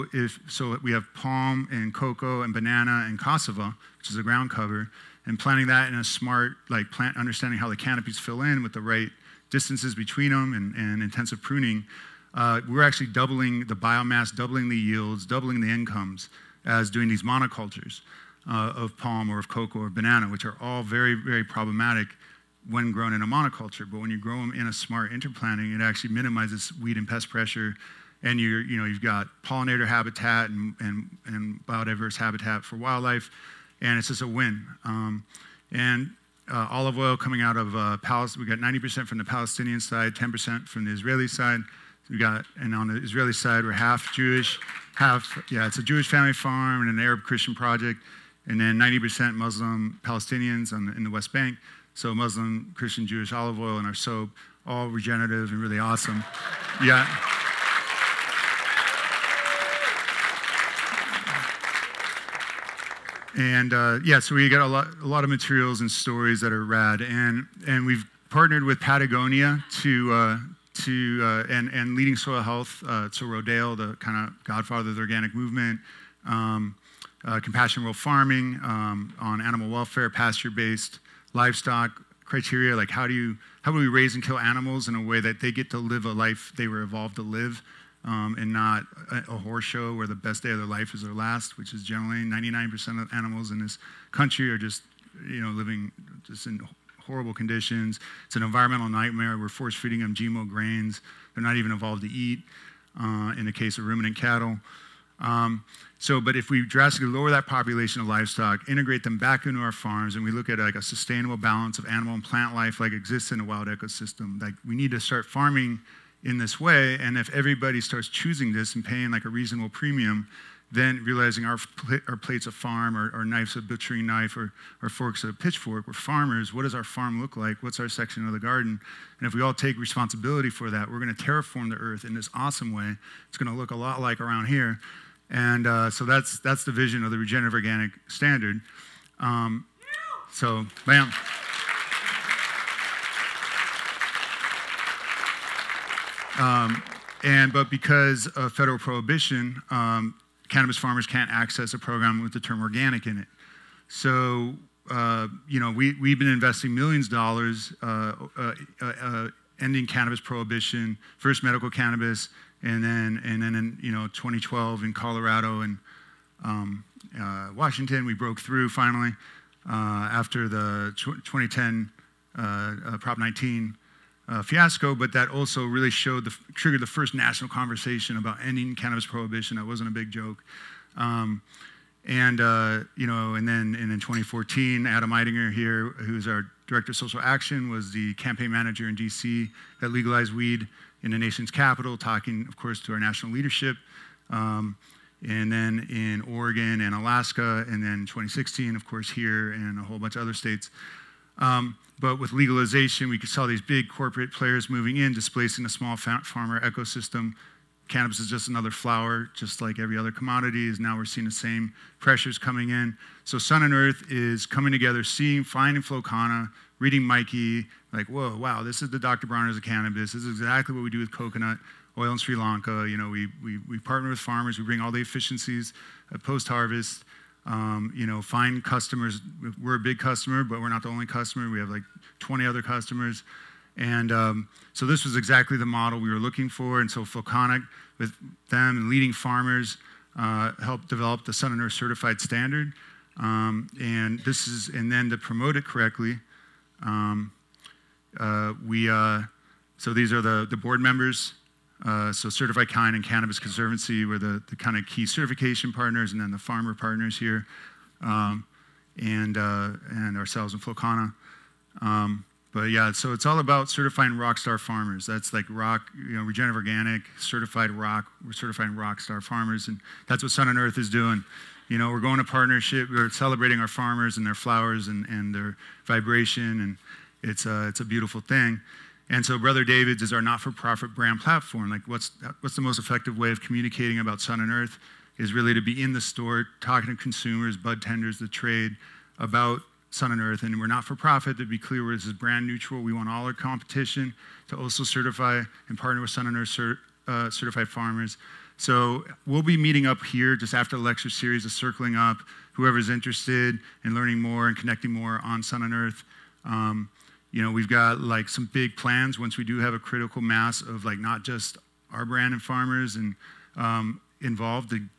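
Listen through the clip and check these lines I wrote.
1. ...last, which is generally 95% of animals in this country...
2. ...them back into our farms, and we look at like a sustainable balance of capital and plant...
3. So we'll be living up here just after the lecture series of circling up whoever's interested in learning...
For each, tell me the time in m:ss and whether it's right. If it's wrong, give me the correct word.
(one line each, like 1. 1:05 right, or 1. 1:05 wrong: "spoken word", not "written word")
1. 1:31 wrong: "99", not "95"
2. 1:49 wrong: "animal", not "capital"
3. 4:58 wrong: "meeting", not "living".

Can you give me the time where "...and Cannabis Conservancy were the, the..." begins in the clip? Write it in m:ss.
4:12.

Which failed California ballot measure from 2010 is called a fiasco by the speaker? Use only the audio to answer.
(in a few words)
Prop 19.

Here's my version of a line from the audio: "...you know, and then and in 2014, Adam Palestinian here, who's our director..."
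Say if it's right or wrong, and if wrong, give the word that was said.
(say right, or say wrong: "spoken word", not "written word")
wrong: "Eidinger", not "Palestinian".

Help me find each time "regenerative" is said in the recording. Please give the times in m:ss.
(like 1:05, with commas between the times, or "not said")
0:54, 2:17, 4:26.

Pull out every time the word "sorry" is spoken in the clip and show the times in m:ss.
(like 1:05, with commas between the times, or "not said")
not said.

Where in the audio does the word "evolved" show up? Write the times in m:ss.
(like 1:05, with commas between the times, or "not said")
1:26, 1:41.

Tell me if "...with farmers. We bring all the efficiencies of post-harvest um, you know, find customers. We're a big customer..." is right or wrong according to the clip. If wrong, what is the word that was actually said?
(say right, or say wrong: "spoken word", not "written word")
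right.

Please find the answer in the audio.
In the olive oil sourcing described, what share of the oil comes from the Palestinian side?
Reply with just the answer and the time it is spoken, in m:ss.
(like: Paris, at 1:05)
90%, at 0:38.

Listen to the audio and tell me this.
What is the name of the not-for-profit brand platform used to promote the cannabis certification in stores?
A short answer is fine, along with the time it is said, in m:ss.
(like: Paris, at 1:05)
Brother David's, at 4:39.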